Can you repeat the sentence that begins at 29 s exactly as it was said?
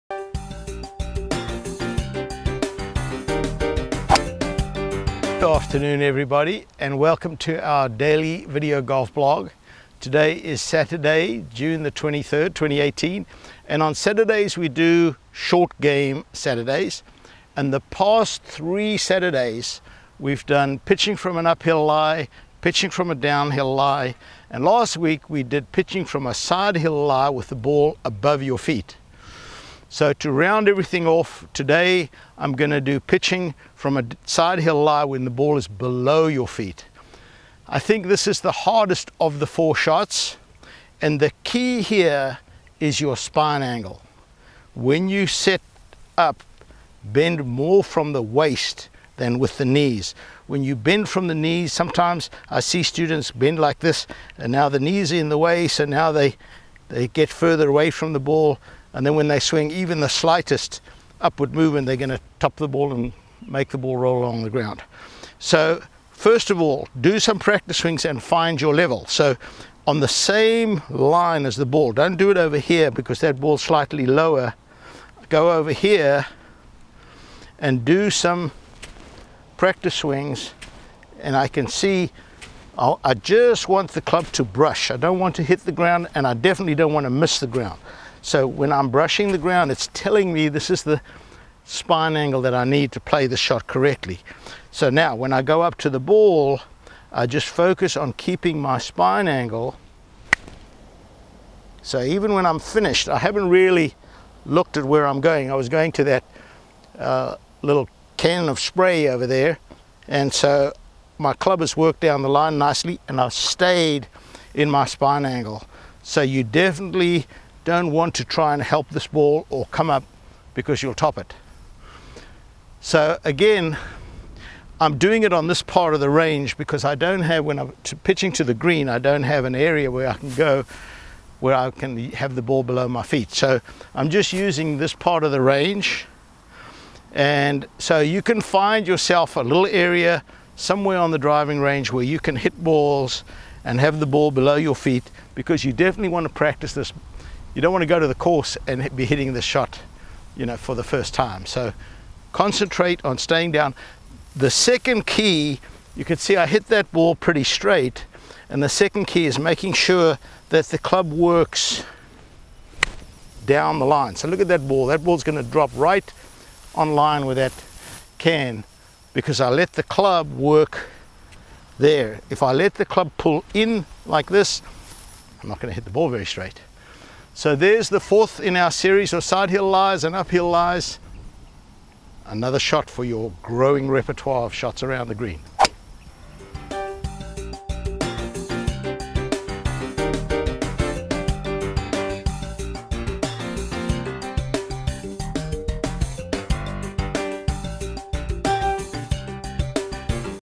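So to round everything off today, I'm gonna do pitching from a side hill lie when the ball is below your feet.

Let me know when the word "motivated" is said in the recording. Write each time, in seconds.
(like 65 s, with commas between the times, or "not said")
not said.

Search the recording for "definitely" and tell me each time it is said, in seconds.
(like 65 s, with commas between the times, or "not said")
86 s, 116 s, 145 s.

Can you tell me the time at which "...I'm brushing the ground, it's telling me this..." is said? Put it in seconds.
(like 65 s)
88 s.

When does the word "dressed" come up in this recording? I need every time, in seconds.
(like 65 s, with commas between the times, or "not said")
not said.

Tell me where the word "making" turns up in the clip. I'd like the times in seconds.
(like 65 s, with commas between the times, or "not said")
159 s.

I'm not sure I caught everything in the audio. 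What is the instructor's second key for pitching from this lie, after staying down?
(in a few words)
Club works down the line.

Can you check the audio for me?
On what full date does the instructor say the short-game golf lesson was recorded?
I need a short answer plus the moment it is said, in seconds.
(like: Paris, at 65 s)
June 23rd, 2018, at 11 s.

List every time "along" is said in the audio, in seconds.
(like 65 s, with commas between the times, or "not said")
64 s.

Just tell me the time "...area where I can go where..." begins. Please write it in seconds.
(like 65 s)
129 s.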